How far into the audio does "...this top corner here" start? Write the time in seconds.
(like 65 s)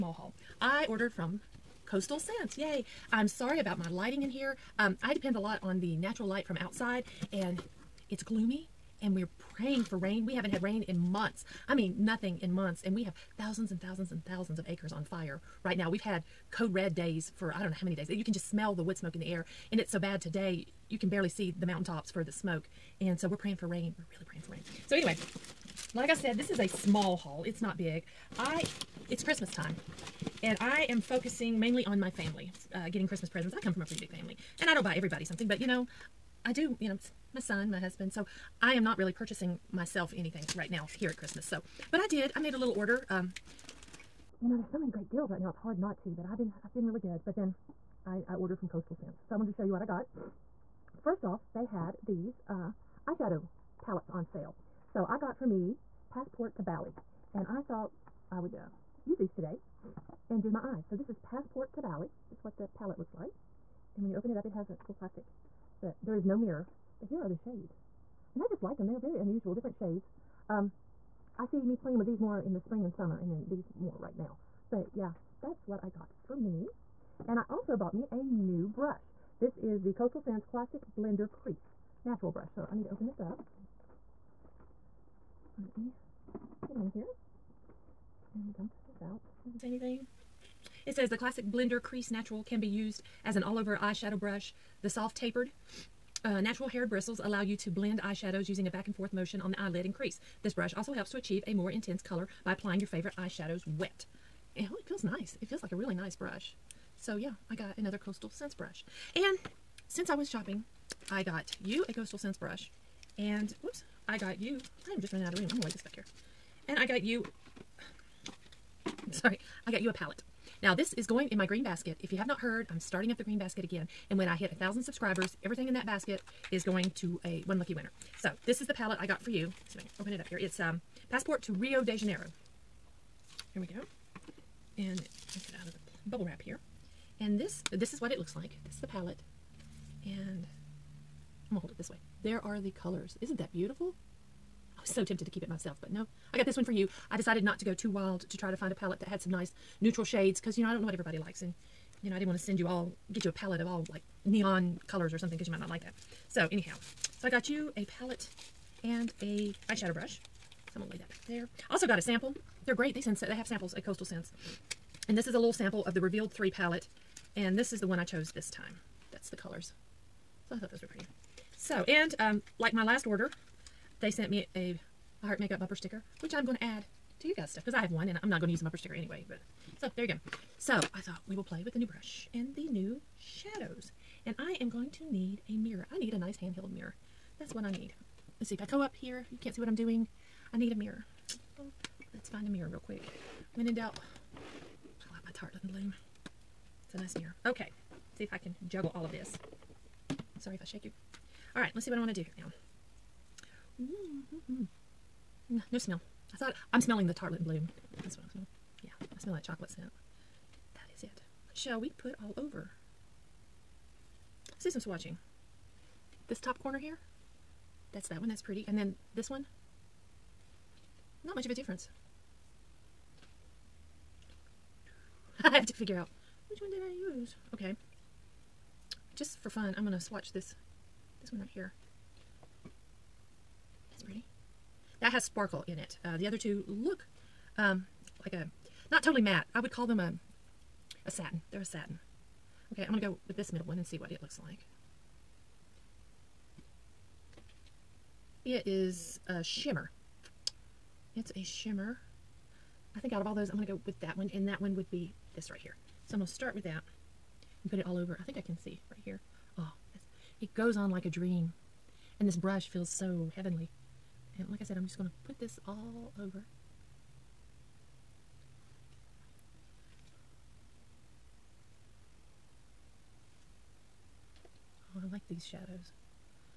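216 s.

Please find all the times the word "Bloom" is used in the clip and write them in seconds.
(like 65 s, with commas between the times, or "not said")
195 s, 207 s.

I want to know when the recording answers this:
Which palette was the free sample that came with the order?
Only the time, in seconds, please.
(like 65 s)
165 s.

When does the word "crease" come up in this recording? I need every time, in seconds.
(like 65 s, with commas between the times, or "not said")
81 s, 91 s, 99 s.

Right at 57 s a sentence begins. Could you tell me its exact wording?
And I thought I would uh, use these today and do my eyes.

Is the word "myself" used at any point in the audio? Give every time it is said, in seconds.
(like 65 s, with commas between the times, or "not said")
39 s, 145 s.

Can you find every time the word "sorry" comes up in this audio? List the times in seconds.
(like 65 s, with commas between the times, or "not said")
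3 s, 119 s, 200 s.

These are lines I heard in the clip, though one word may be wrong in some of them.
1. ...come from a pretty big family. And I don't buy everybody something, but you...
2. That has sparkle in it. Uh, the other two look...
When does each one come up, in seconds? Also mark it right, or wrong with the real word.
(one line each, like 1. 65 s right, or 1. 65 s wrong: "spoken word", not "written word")
1. 33 s right
2. 235 s right.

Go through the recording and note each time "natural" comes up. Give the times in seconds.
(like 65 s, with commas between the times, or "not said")
5 s, 82 s, 92 s, 96 s.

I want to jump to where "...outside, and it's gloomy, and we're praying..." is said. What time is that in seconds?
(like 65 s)
6 s.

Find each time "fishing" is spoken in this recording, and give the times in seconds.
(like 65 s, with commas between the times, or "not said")
not said.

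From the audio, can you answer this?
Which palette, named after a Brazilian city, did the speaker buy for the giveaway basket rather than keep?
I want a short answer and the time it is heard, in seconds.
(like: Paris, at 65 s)
Passport to Rio de Janeiro, at 131 s.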